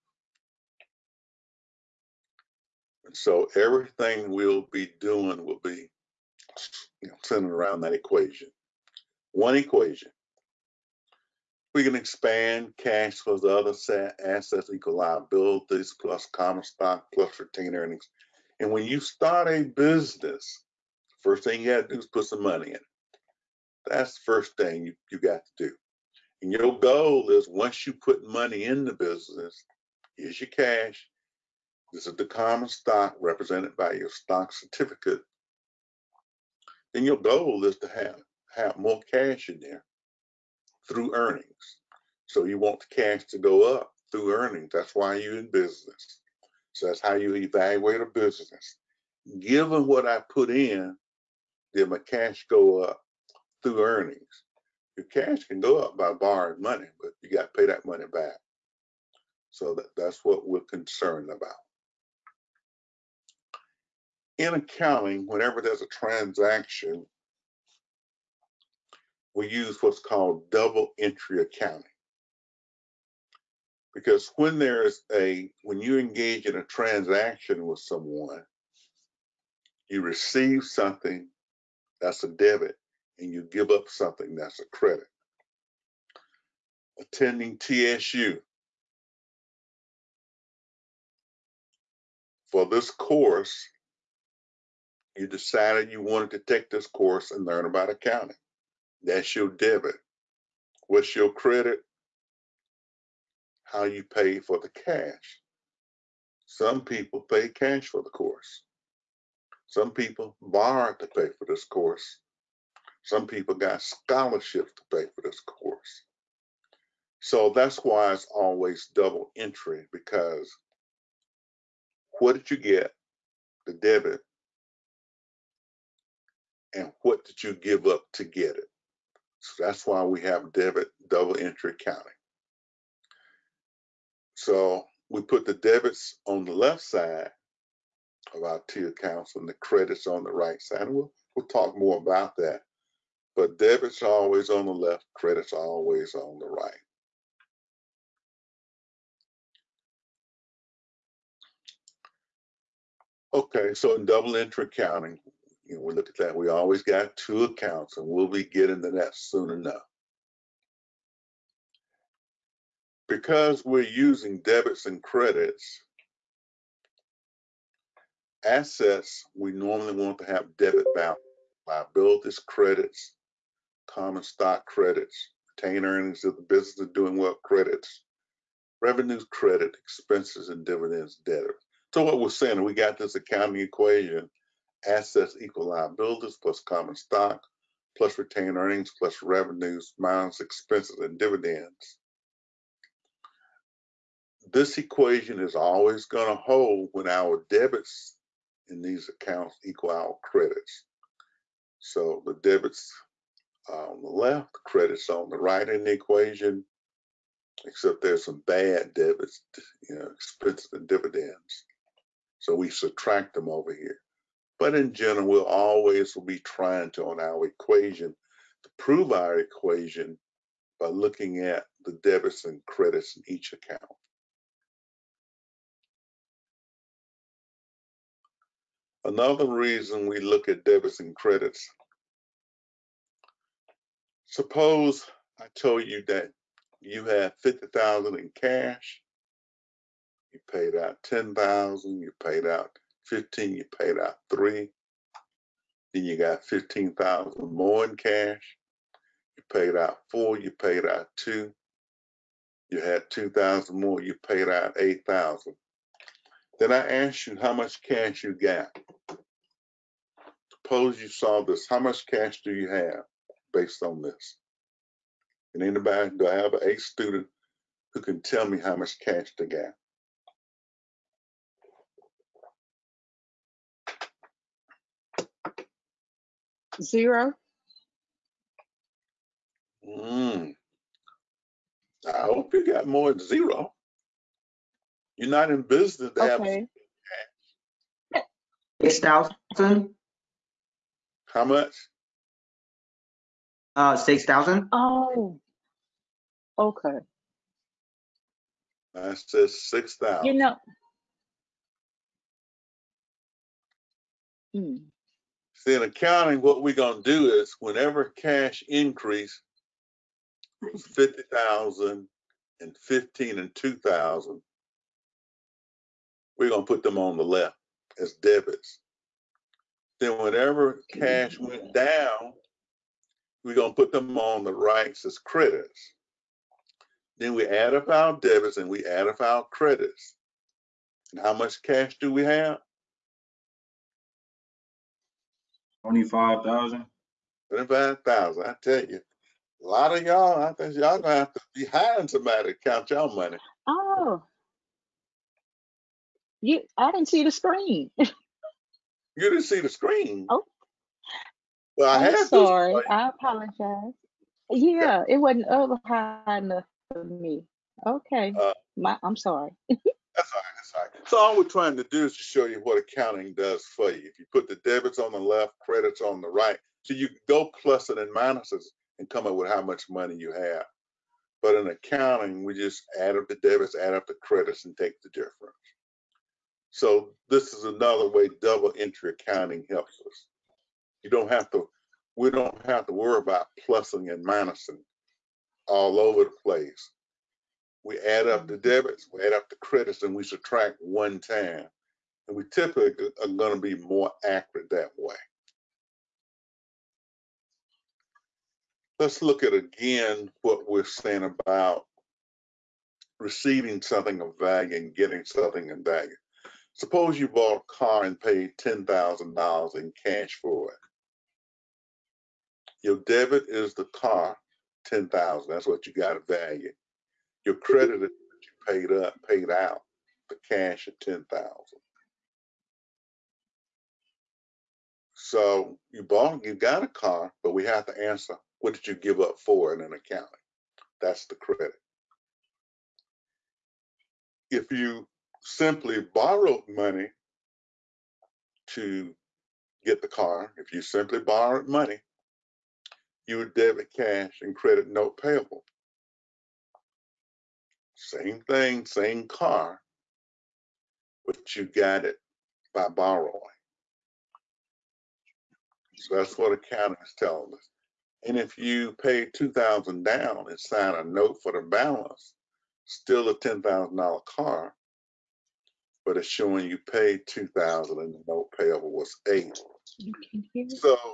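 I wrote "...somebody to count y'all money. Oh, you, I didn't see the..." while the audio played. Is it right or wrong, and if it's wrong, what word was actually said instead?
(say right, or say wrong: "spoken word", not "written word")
right.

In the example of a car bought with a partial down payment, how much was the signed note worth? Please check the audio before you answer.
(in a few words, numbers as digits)
8,000.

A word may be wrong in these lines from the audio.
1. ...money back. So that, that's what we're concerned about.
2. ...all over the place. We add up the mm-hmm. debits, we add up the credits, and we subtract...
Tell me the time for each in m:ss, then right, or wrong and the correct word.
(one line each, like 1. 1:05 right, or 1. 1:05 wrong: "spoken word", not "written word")
1. 0:57 right
2. 6:25 right.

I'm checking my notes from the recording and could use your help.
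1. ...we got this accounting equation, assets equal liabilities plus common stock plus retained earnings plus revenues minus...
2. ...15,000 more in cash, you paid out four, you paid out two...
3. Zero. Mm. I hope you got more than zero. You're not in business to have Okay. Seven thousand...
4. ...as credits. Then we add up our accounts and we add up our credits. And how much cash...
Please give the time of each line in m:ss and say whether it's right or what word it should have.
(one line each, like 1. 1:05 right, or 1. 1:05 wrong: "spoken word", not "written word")
1. 3:02 right
2. 4:06 right
3. 4:36 wrong: "Six", not "Seven"
4. 5:25 wrong: "debits", not "accounts".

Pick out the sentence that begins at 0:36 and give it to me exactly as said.
Then your goal is to have, have more cash in there through earnings.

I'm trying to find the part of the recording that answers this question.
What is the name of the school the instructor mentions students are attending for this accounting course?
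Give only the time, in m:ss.
1:27.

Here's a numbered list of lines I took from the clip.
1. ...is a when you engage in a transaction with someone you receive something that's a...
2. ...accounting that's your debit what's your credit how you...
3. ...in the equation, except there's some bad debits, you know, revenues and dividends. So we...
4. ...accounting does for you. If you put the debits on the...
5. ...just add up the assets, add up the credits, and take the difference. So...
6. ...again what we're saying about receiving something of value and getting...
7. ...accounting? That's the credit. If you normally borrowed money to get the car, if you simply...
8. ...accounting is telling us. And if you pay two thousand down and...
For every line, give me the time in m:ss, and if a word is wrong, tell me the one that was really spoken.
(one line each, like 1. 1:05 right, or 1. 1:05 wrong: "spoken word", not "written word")
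1. 1:14 right
2. 1:37 right
3. 3:25 wrong: "expenses", not "revenues"
4. 6:02 right
5. 6:12 wrong: "debits", not "assets"
6. 6:39 right
7. 7:09 wrong: "simply", not "normally"
8. 7:36 right.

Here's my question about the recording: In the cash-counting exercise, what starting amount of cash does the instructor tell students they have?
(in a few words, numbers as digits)
50,000.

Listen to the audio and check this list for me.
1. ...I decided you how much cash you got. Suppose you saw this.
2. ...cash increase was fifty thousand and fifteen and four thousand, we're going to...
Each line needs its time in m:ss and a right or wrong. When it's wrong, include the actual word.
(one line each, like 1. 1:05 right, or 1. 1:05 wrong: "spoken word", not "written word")
1. 4:16 wrong: "asked", not "decided"
2. 5:08 wrong: "two", not "four".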